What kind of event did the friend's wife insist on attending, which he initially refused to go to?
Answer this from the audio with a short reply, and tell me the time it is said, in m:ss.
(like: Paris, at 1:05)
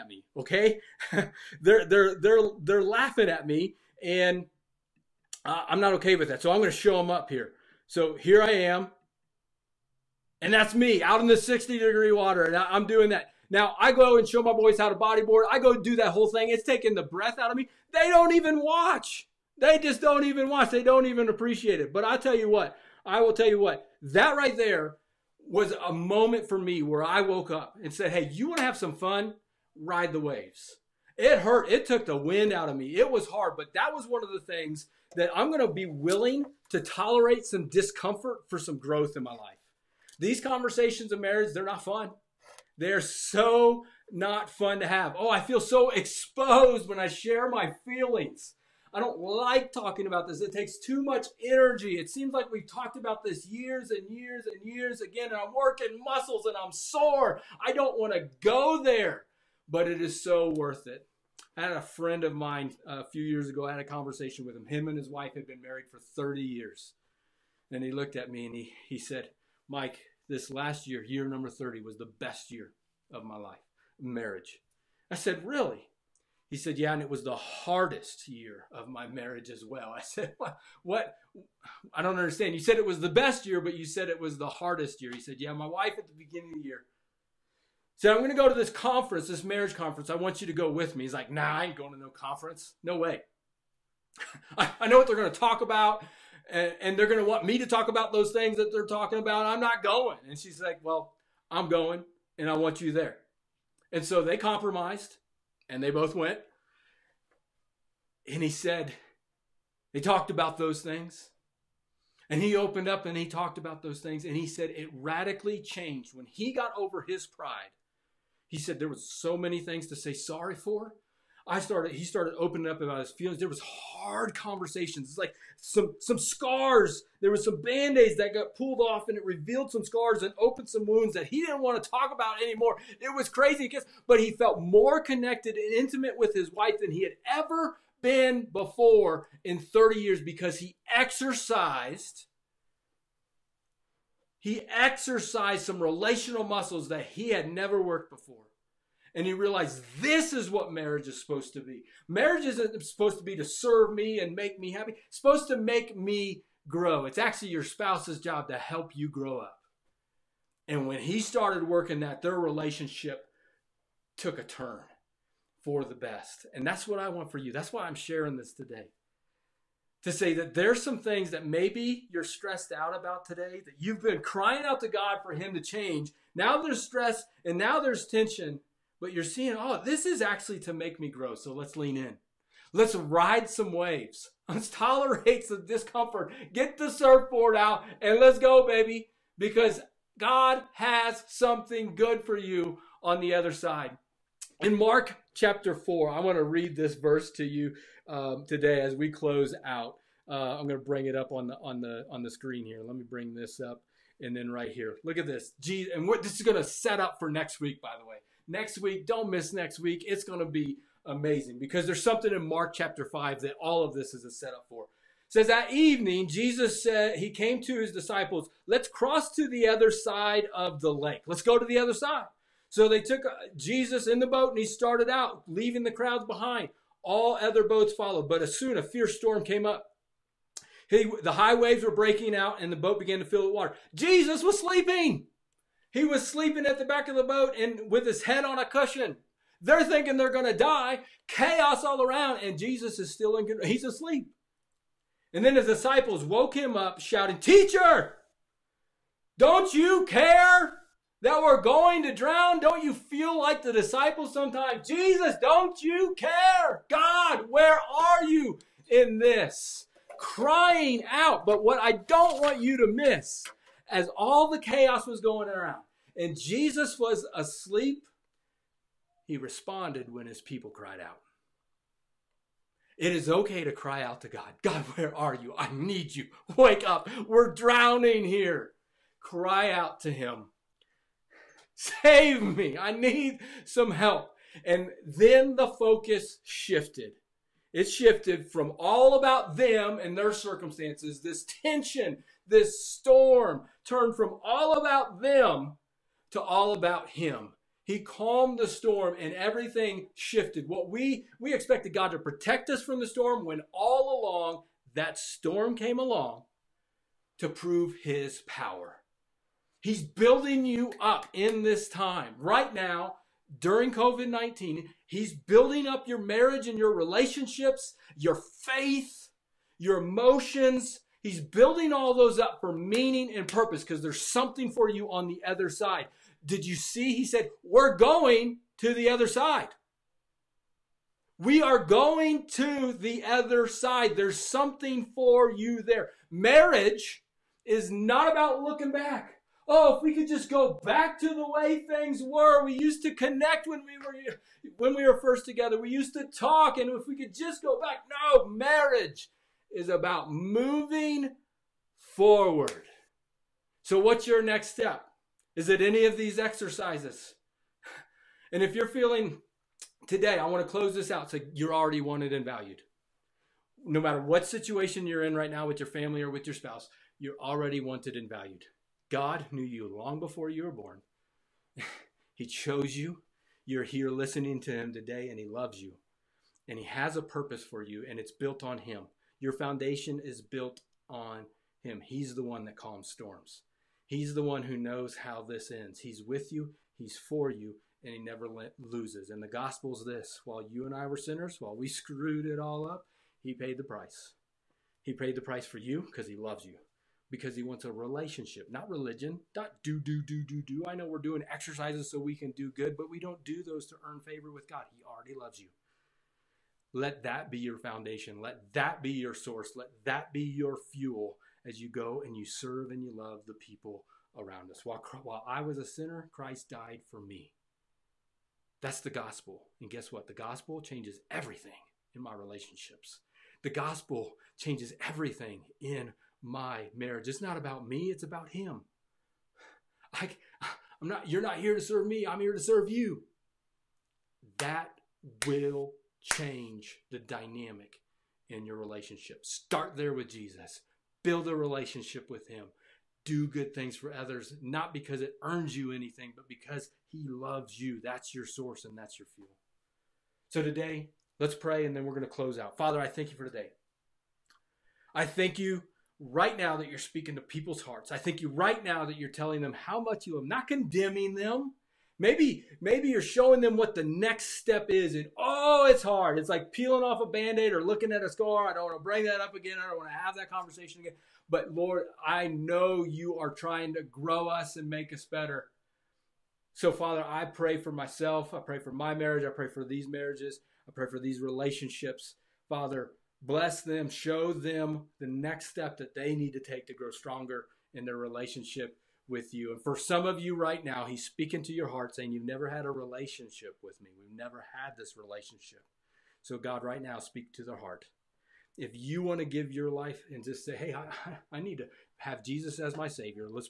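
Marriage conference, at 1:29.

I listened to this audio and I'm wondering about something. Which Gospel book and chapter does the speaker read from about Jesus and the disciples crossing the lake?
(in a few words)
Mark chapter 4.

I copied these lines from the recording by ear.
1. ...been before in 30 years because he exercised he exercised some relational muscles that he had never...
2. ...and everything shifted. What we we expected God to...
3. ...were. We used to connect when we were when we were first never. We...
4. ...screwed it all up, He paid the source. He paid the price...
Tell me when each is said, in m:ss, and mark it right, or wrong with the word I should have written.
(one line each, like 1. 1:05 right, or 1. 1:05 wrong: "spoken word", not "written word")
1. 2:18 right
2. 4:59 right
3. 5:42 wrong: "together", not "never"
4. 6:31 wrong: "price", not "source".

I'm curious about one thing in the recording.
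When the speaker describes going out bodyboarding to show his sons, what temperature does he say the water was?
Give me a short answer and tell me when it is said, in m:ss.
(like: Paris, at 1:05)
60 degrees, at 0:11.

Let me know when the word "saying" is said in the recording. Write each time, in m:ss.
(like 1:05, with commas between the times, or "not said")
8:12.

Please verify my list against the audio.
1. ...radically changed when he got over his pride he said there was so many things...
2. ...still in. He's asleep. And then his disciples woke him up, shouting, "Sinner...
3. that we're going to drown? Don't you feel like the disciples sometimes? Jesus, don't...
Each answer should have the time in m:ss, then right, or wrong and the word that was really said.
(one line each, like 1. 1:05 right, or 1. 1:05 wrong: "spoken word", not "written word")
1. 1:54 right
2. 4:03 wrong: "Teacher", not "Sinner"
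3. 4:11 right.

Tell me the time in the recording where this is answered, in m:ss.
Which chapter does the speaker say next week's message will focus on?
3:32.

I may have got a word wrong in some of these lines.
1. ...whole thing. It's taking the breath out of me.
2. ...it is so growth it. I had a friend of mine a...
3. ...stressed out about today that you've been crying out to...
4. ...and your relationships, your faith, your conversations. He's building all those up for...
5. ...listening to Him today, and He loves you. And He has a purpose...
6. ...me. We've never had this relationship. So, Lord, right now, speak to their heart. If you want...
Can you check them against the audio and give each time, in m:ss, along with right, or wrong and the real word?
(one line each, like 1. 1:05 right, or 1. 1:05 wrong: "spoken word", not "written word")
1. 0:16 right
2. 0:59 wrong: "worth", not "growth"
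3. 2:52 right
4. 5:16 wrong: "emotions", not "conversations"
5. 6:14 right
6. 8:14 wrong: "God", not "Lord".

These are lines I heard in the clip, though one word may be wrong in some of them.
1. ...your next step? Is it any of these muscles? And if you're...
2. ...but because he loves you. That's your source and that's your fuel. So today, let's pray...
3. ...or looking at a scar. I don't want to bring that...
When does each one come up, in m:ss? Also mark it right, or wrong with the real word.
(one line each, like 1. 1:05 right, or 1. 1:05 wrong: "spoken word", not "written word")
1. 5:54 wrong: "exercises", not "muscles"
2. 7:26 right
3. 7:47 right.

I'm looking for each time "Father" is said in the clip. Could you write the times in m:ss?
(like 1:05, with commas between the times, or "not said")
7:32, 7:56, 8:02.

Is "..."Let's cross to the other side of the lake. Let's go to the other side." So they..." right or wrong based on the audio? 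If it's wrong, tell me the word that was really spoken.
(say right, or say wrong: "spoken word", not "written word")
right.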